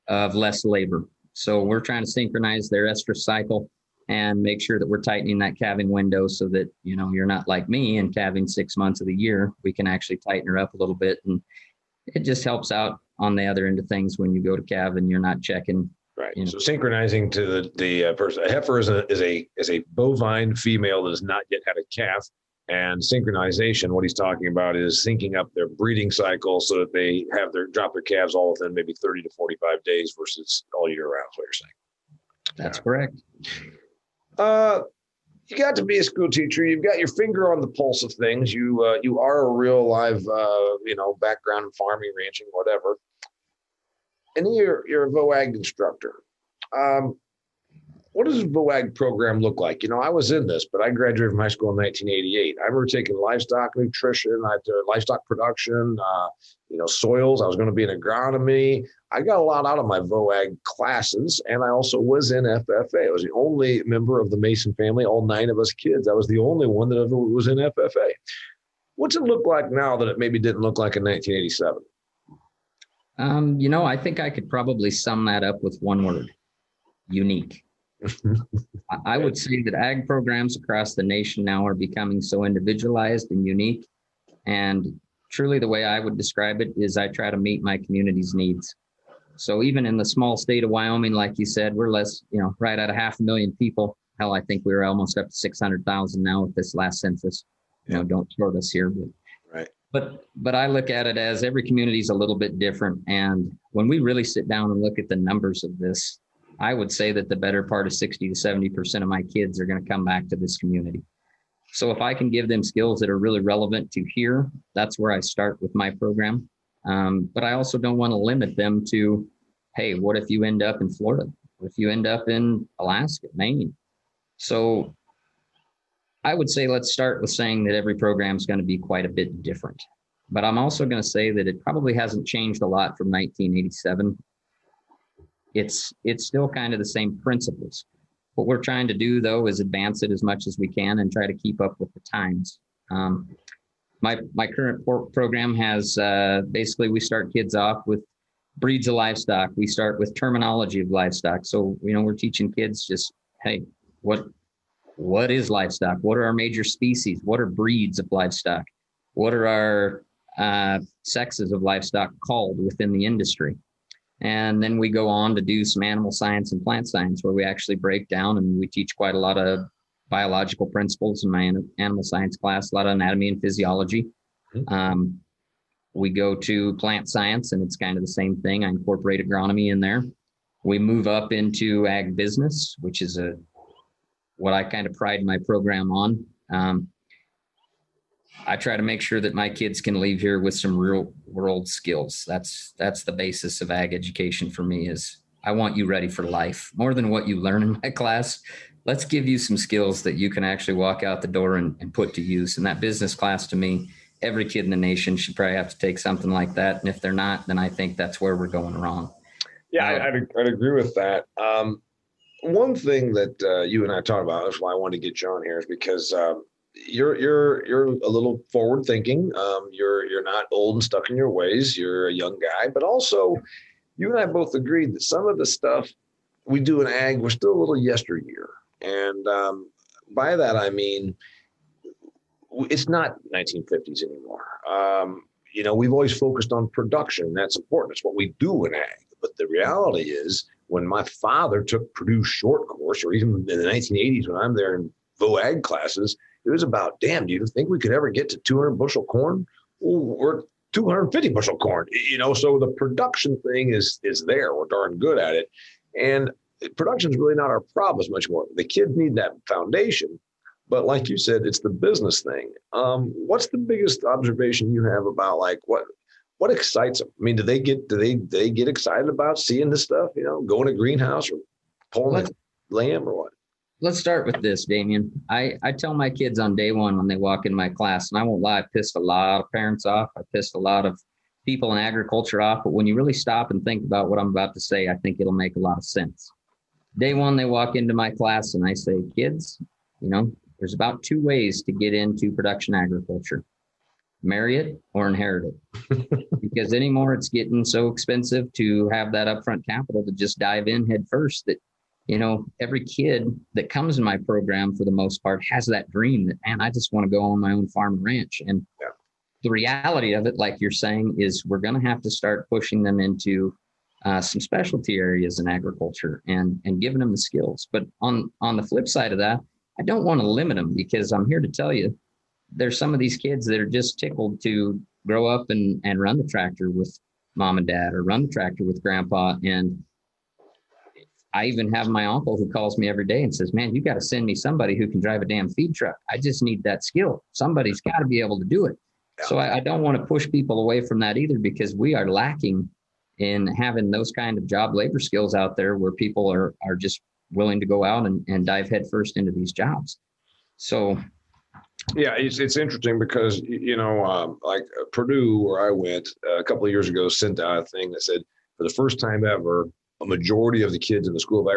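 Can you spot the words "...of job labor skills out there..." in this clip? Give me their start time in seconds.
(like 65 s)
344 s.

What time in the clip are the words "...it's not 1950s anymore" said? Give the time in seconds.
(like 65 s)
232 s.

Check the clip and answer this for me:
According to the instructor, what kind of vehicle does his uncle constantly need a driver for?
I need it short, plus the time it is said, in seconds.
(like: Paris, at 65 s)
feed truck, at 335 s.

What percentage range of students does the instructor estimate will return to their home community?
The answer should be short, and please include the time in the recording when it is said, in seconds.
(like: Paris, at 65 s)
60 to 70%, at 107 s.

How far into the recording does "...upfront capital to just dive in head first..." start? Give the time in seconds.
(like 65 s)
299 s.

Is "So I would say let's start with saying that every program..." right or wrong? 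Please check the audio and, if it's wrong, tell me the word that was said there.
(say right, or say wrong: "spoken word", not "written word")
right.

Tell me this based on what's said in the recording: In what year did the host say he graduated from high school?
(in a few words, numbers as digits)
1988.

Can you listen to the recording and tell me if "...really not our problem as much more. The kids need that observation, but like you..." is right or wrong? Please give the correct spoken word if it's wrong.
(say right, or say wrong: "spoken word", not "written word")
wrong: "foundation", not "observation".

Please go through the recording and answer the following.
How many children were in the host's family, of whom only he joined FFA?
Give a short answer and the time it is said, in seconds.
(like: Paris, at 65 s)
9, at 65 s.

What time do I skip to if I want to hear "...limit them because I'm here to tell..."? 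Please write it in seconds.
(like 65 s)
320 s.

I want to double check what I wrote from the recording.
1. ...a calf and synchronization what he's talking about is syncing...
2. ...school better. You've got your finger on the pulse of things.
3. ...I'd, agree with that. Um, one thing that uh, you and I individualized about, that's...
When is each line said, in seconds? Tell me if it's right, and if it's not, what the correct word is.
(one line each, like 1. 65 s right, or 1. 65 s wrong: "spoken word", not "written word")
1. 21 s right
2. 36 s wrong: "teacher", not "better"
3. 210 s wrong: "talked", not "individualized".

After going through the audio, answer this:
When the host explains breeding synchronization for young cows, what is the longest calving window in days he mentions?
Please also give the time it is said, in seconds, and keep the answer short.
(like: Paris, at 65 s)
45, at 29 s.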